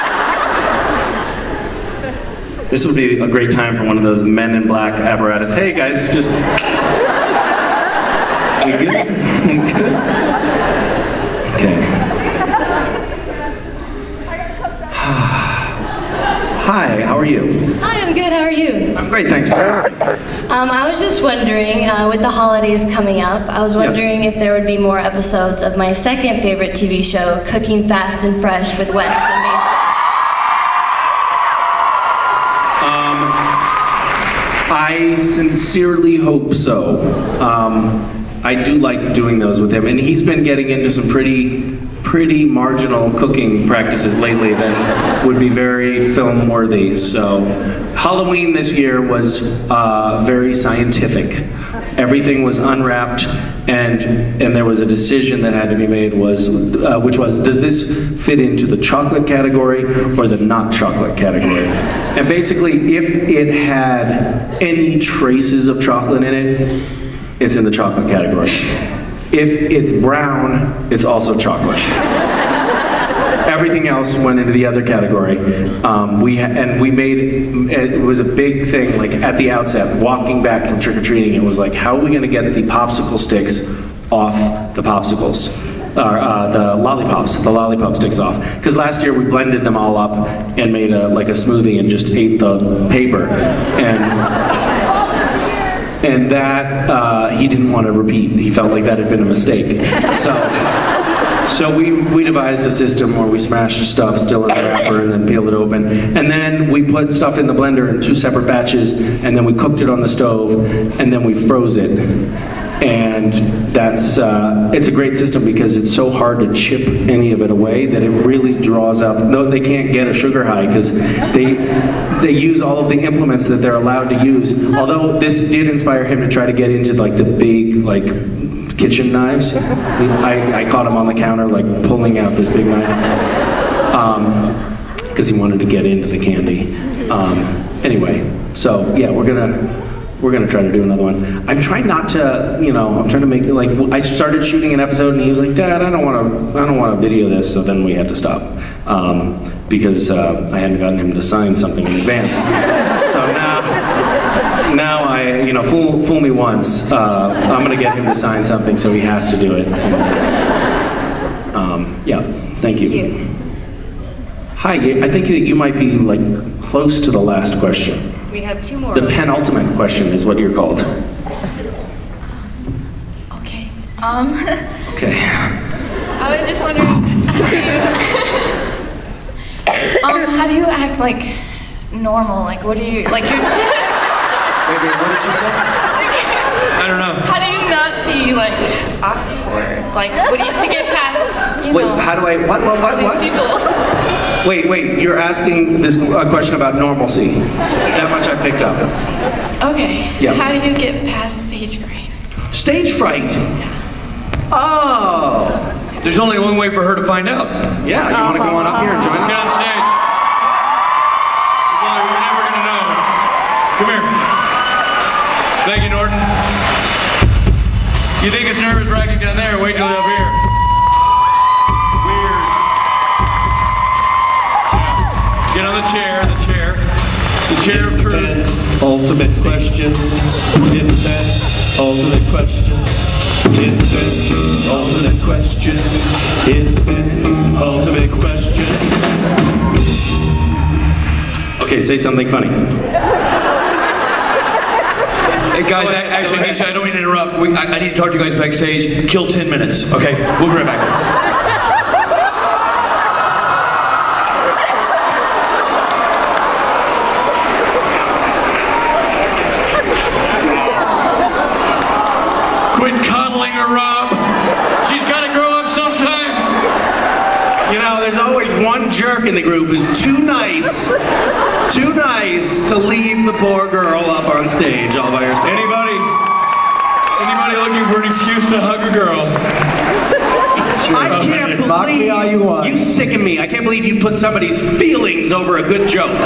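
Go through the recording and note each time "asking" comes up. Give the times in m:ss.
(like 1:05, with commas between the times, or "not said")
0:19, 3:15.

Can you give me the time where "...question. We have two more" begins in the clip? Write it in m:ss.
2:47.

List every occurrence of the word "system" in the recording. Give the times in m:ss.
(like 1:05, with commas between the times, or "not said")
1:42, 1:55.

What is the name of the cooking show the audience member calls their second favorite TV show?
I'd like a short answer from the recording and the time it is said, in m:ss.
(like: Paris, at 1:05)
Cooking Fast and Fresh, at 0:27.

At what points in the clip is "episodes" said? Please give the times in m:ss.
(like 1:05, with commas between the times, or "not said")
0:24, 2:24.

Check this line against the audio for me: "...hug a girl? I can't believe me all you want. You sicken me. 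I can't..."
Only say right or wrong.
right.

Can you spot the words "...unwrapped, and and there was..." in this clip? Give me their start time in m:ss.
0:52.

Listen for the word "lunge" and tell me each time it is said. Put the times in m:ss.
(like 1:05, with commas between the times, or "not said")
not said.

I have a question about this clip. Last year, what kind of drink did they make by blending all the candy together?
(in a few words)
A smoothie.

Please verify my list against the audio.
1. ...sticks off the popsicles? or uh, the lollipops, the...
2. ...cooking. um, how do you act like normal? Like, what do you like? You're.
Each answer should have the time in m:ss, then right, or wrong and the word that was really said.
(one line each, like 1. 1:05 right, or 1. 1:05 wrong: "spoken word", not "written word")
1. 1:23 right
2. 2:56 wrong: "wondering", not "cooking".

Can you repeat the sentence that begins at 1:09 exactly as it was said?
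If it's brown, it's also chocolate.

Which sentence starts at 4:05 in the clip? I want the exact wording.
Hey guys, I, actually, actually, I don't mean to interrupt.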